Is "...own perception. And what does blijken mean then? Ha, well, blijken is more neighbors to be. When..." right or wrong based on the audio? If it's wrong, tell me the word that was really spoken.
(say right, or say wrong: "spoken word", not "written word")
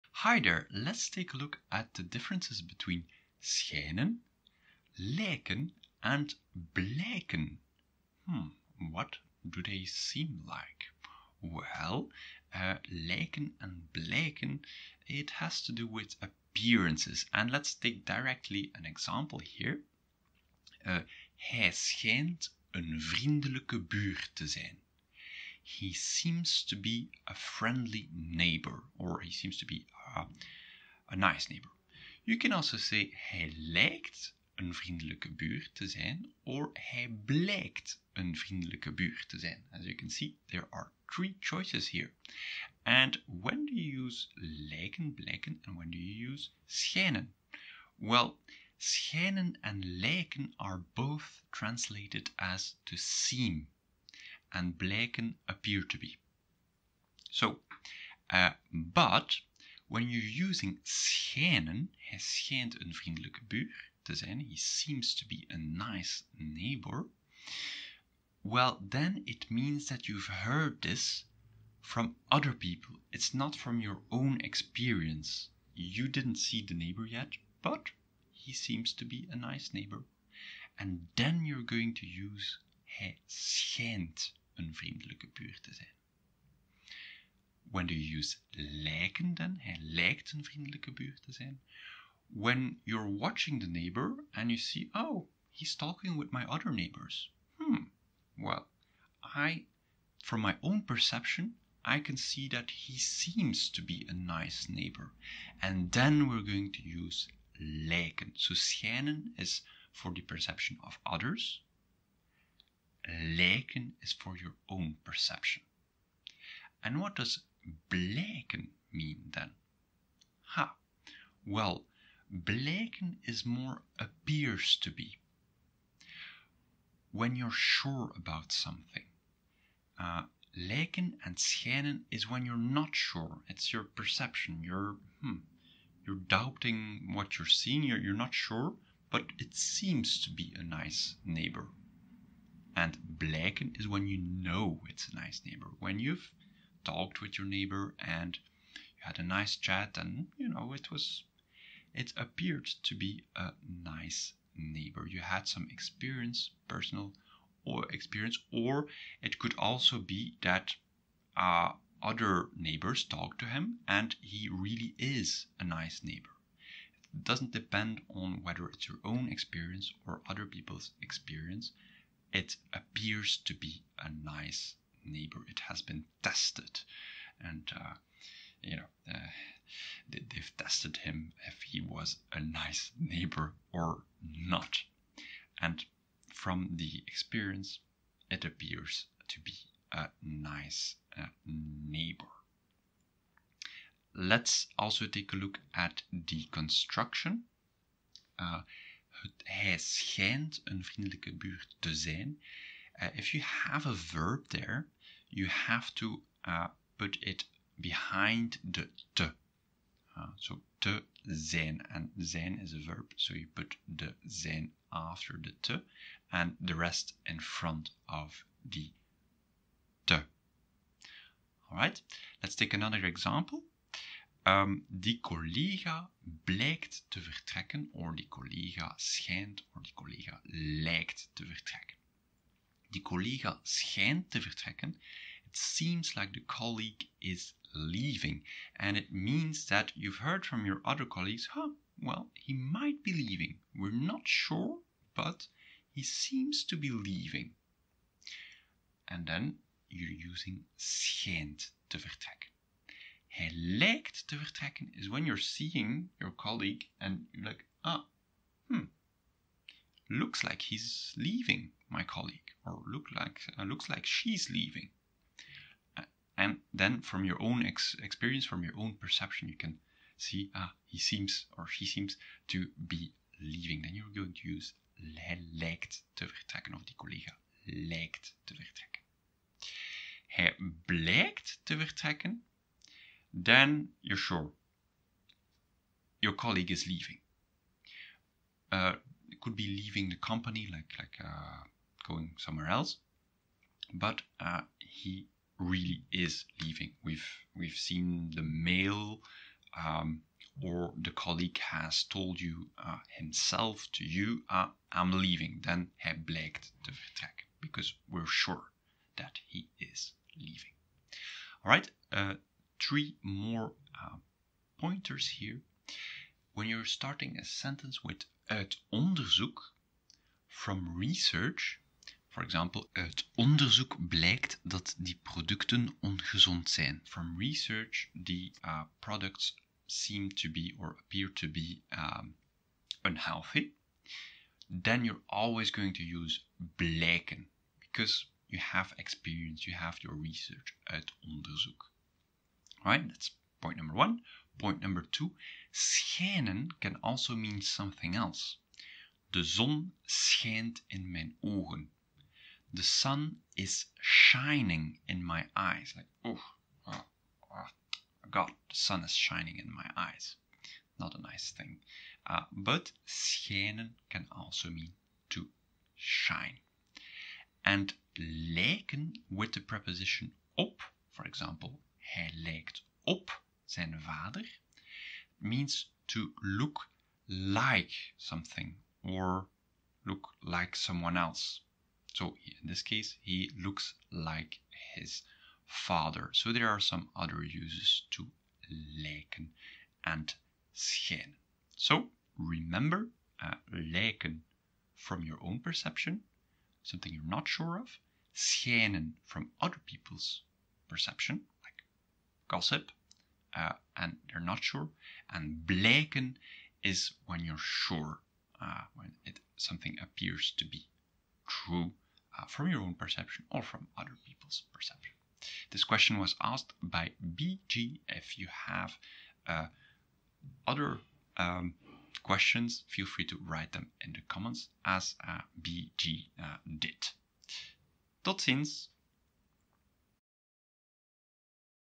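wrong: "appears", not "neighbors".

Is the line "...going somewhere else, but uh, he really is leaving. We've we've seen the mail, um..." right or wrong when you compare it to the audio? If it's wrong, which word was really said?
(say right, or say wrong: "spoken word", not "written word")
right.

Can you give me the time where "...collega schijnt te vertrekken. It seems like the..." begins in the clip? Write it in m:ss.
3:53.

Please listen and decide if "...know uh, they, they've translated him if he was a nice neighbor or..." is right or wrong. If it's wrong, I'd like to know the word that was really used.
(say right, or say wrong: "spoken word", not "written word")
wrong: "tested", not "translated".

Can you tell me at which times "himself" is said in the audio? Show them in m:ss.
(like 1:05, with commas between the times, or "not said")
5:03.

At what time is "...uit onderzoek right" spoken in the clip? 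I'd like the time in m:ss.
5:40.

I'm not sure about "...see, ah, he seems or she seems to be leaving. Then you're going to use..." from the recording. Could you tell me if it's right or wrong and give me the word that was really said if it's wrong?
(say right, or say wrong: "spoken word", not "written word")
right.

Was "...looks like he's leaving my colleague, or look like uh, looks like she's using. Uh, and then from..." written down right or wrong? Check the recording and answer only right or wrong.
wrong.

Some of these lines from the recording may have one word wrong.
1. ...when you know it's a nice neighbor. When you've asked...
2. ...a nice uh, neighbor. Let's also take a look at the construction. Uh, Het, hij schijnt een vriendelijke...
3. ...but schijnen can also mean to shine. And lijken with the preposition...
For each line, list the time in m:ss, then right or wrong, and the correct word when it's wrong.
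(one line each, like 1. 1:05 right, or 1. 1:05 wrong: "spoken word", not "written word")
1. 2:23 wrong: "talked", not "asked"
2. 3:09 right
3. 6:02 right.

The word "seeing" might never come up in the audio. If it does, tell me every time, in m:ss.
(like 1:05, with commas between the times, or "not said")
2:17, 4:15.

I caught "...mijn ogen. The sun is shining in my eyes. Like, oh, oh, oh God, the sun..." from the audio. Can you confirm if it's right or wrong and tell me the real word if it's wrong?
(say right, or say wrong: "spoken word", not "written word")
right.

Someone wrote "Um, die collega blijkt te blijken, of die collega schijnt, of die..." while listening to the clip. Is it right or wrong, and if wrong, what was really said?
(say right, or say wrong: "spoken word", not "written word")
wrong: "vertrekken", not "blijken".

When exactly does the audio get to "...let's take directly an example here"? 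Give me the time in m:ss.
0:17.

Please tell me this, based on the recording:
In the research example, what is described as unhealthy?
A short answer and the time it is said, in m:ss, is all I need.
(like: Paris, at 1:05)
producten, at 5:25.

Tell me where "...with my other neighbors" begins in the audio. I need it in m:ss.
1:36.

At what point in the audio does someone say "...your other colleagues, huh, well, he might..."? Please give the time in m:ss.
4:00.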